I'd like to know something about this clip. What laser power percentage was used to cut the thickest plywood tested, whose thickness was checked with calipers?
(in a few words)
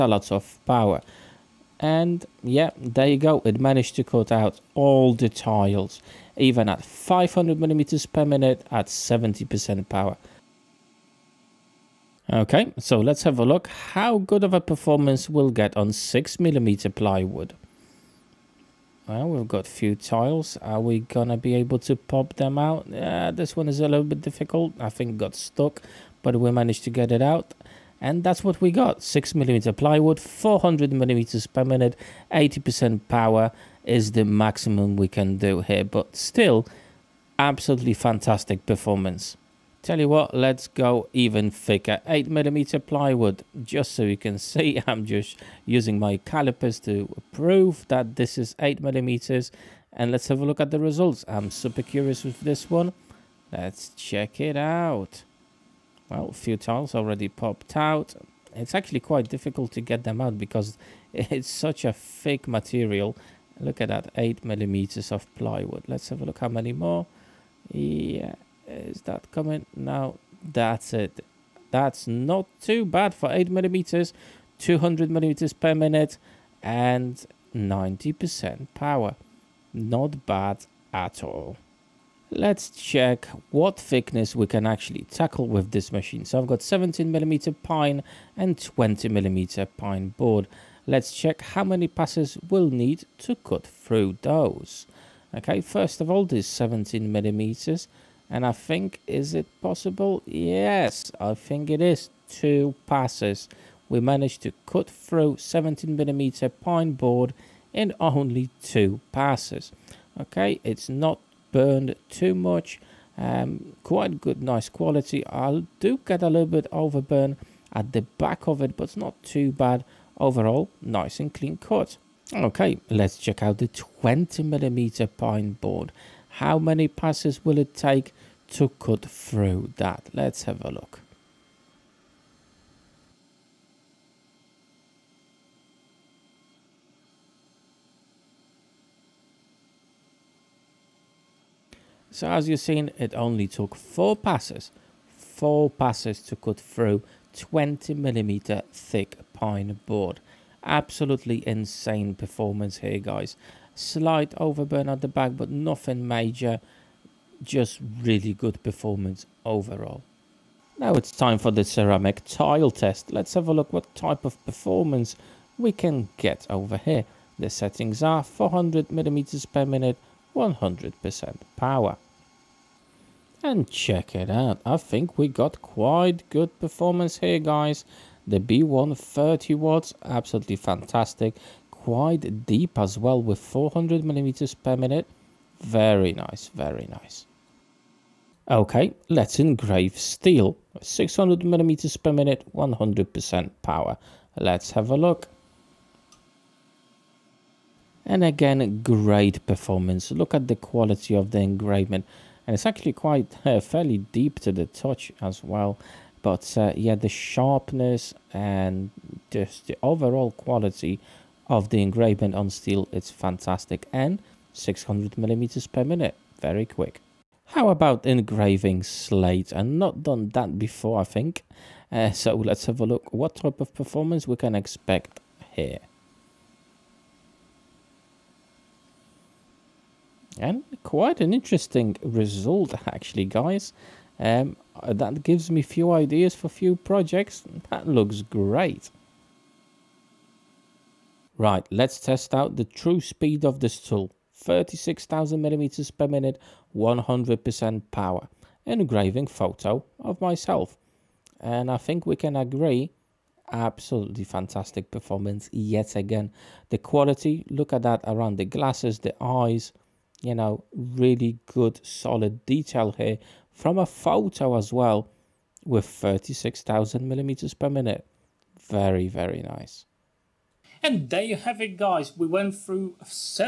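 90%.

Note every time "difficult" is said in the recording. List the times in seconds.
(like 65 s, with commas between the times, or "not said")
24 s, 59 s.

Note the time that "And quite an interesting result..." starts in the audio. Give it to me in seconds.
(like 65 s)
230 s.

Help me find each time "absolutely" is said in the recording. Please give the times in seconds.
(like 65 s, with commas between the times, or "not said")
37 s, 150 s, 180 s, 253 s.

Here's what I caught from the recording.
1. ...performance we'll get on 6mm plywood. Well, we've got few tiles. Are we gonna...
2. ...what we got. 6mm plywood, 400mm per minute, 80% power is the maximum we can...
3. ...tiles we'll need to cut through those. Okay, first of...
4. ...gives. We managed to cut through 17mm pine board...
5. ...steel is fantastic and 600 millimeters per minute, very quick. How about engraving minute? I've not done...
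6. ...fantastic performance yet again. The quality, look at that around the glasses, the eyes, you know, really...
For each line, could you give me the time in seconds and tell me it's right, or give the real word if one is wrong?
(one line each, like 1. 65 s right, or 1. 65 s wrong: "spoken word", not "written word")
1. 14 s right
2. 28 s right
3. 91 s wrong: "passes", not "tiles"
4. 102 s wrong: "passes", not "gives"
5. 212 s wrong: "slate", not "minute"
6. 254 s right.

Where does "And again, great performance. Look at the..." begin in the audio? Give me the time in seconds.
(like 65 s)
198 s.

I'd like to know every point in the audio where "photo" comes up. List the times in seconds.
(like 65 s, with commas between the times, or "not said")
249 s, 263 s.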